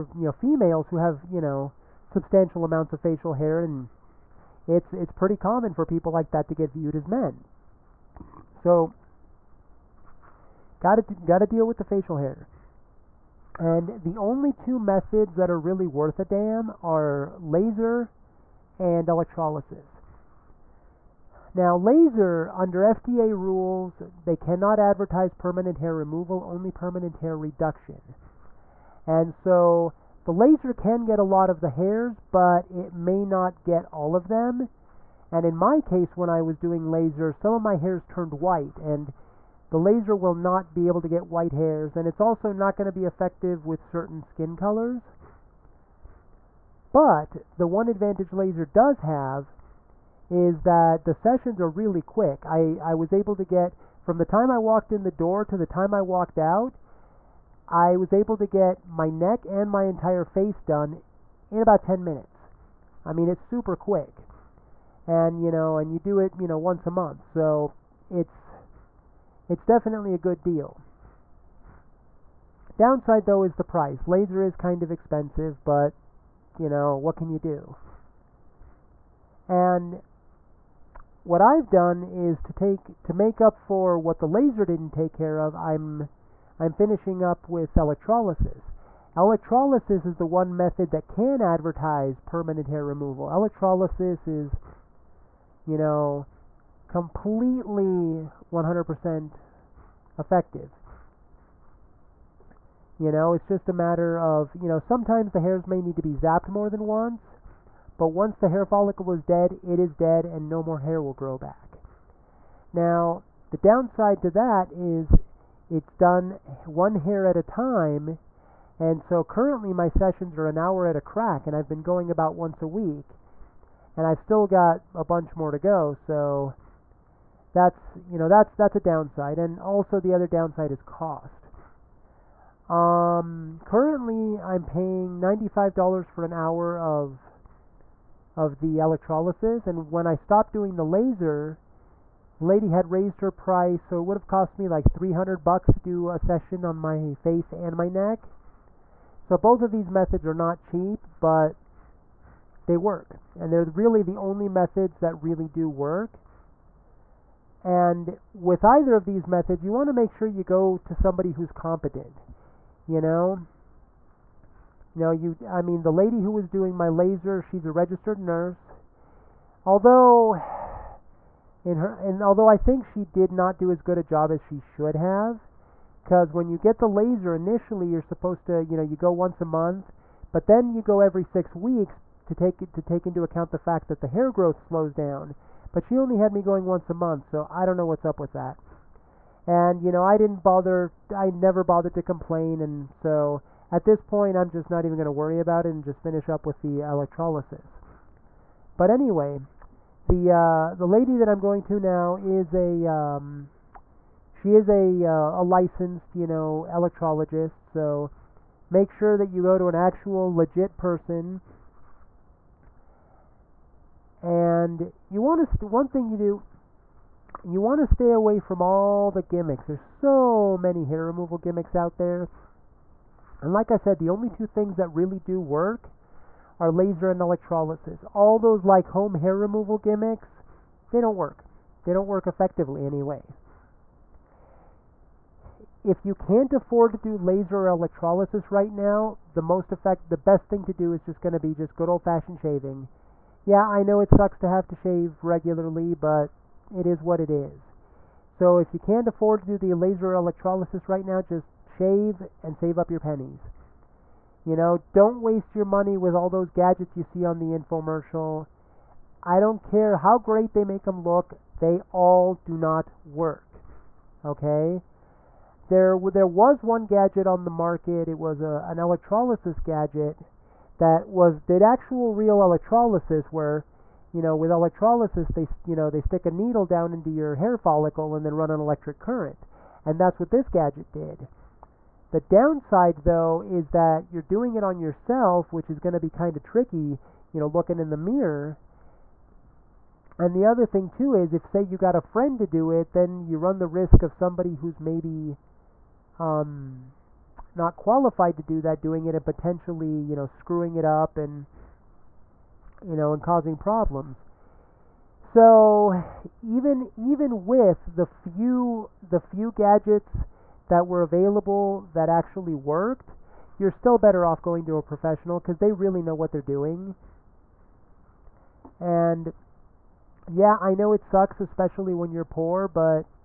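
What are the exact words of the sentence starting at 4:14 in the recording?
You know, don't waste your money with all those gadgets you see on the infomercial.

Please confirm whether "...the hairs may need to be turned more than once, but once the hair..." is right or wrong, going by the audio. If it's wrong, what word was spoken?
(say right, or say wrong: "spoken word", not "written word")
wrong: "zapped", not "turned".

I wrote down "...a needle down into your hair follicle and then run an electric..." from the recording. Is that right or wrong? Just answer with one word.
right.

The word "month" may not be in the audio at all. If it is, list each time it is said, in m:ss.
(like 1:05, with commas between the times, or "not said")
1:06, 2:59, 3:06.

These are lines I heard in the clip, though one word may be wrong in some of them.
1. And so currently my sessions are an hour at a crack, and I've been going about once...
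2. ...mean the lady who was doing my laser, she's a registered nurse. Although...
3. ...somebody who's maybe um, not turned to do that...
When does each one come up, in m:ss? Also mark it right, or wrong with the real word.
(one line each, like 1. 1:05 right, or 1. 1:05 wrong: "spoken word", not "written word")
1. 1:58 right
2. 2:45 right
3. 4:54 wrong: "qualified", not "turned".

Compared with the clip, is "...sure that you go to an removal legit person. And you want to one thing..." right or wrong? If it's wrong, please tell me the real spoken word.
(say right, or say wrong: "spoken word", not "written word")
wrong: "actual", not "removal".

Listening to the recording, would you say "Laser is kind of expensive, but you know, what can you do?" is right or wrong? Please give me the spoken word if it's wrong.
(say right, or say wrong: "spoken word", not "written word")
right.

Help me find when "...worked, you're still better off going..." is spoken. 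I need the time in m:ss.
5:12.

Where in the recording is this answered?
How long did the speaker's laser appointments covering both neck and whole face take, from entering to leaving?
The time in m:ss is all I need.
1:01.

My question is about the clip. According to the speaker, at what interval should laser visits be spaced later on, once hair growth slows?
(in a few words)
every 6 weeks.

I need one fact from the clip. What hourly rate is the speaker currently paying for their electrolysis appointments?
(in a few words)
$95.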